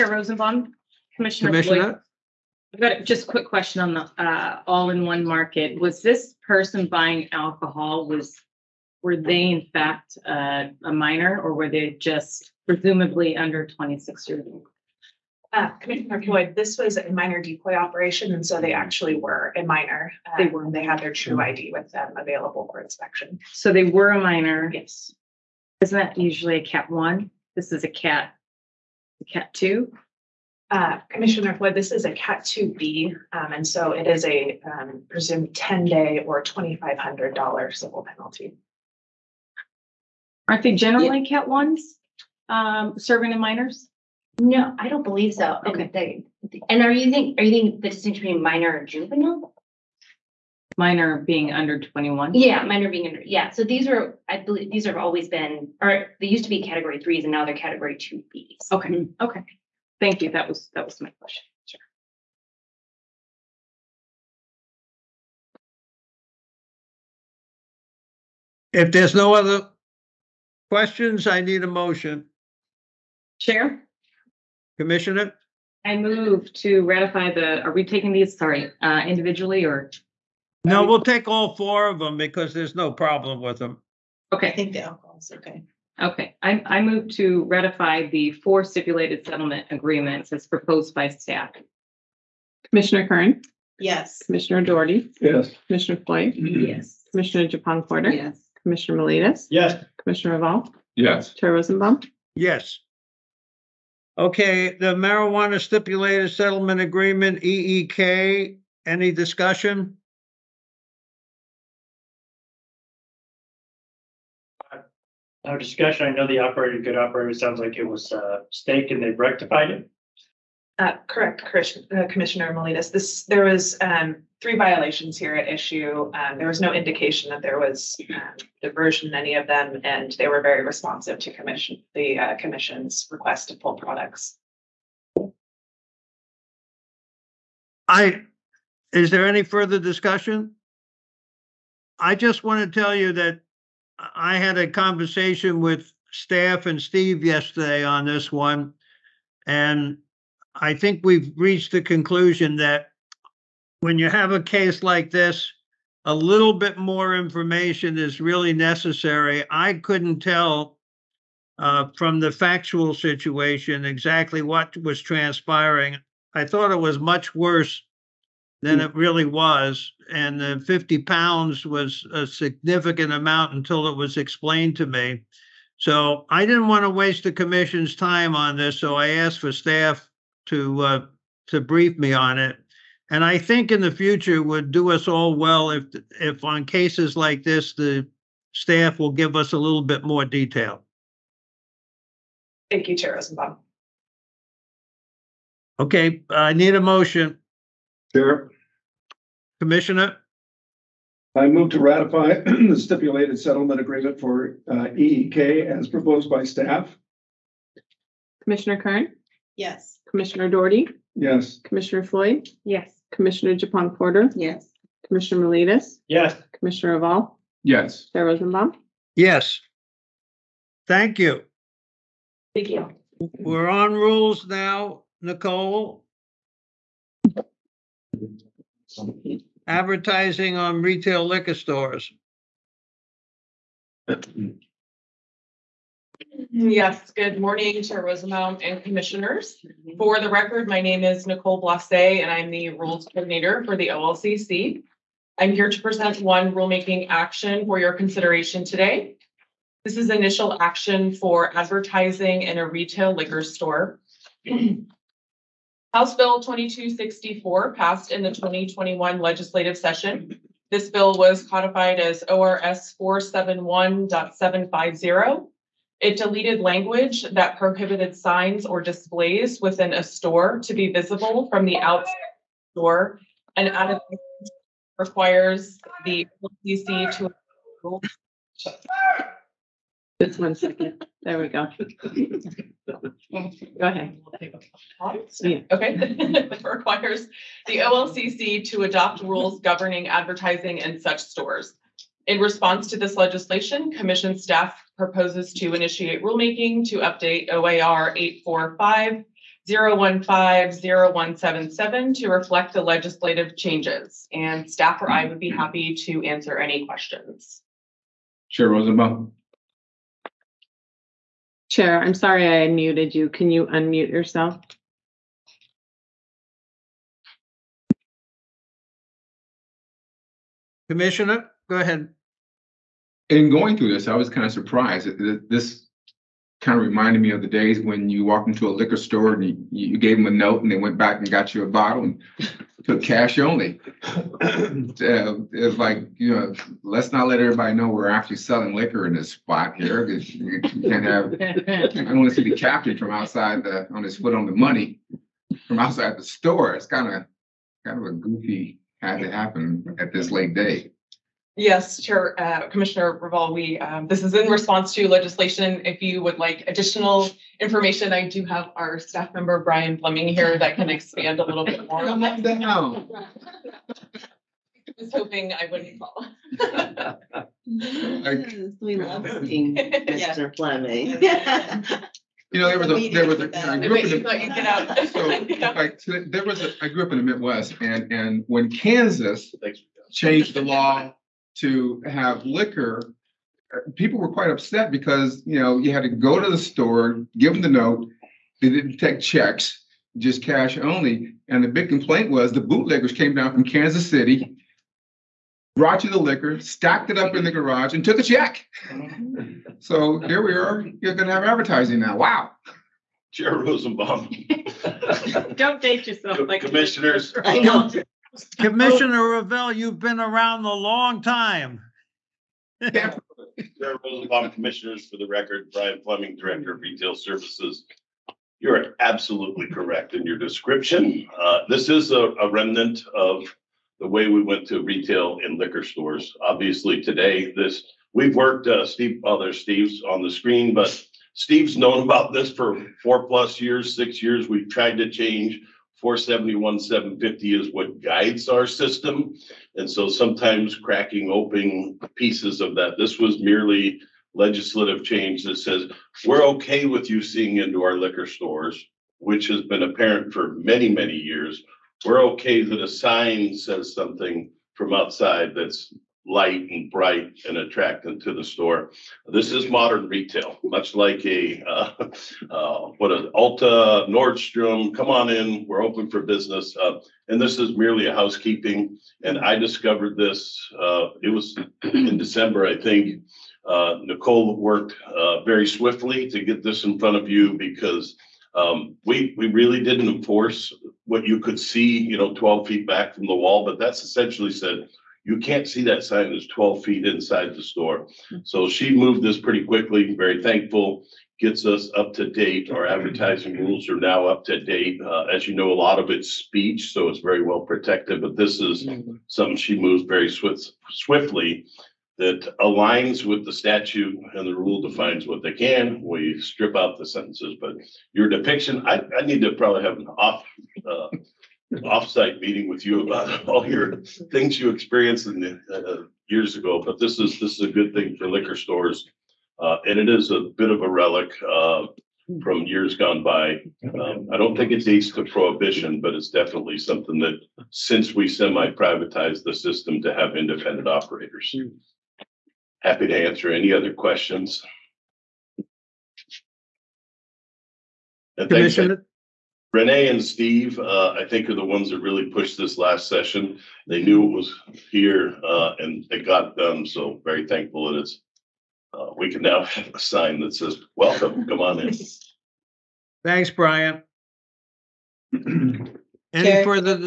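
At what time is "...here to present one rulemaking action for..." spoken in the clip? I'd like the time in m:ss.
4:05.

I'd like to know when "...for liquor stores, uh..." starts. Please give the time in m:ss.
8:38.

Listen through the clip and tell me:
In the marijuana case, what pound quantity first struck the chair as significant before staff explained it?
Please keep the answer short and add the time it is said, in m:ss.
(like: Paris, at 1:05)
50 pounds, at 2:50.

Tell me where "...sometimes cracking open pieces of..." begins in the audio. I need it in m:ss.
7:20.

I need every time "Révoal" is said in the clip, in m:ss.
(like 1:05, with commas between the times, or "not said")
1:40, 5:53, 6:49.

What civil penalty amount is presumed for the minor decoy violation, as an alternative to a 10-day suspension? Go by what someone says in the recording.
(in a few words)
$2,500.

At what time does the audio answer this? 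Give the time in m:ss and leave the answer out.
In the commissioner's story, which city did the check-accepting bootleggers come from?
6:33.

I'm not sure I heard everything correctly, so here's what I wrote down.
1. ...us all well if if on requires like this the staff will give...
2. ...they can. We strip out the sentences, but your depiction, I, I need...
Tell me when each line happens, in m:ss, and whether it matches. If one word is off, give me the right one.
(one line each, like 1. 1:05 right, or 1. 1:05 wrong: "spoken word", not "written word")
1. 3:04 wrong: "cases", not "requires"
2. 8:25 right.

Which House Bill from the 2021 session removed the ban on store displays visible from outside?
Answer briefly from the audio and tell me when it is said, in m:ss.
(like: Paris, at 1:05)
House Bill 2264, at 4:15.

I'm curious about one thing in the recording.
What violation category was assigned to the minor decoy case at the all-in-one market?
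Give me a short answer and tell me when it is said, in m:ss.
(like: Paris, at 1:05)
CAT 2B, at 0:32.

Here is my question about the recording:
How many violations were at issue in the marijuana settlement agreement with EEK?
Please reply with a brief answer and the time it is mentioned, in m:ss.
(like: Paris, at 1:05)
3, at 2:04.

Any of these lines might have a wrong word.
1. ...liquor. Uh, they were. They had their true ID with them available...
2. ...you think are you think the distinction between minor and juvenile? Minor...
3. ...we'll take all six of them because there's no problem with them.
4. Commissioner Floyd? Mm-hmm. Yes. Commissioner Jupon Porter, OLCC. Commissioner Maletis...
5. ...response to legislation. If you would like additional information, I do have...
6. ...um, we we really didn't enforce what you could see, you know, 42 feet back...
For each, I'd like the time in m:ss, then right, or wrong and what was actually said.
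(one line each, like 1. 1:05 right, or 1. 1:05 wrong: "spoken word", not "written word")
1. 0:19 wrong: "minor", not "liquor"
2. 0:46 right
3. 1:20 wrong: "four", not "six"
4. 1:35 wrong: "Yes", not "OLCC"
5. 5:54 right
6. 7:58 wrong: "12", not "42".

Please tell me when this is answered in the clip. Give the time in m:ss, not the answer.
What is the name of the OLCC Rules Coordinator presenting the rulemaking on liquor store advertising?
4:01.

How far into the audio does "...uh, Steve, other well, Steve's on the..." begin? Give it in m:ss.
7:08.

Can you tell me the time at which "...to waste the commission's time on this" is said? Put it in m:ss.
2:56.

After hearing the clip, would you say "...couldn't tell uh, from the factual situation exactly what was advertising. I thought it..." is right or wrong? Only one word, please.
wrong.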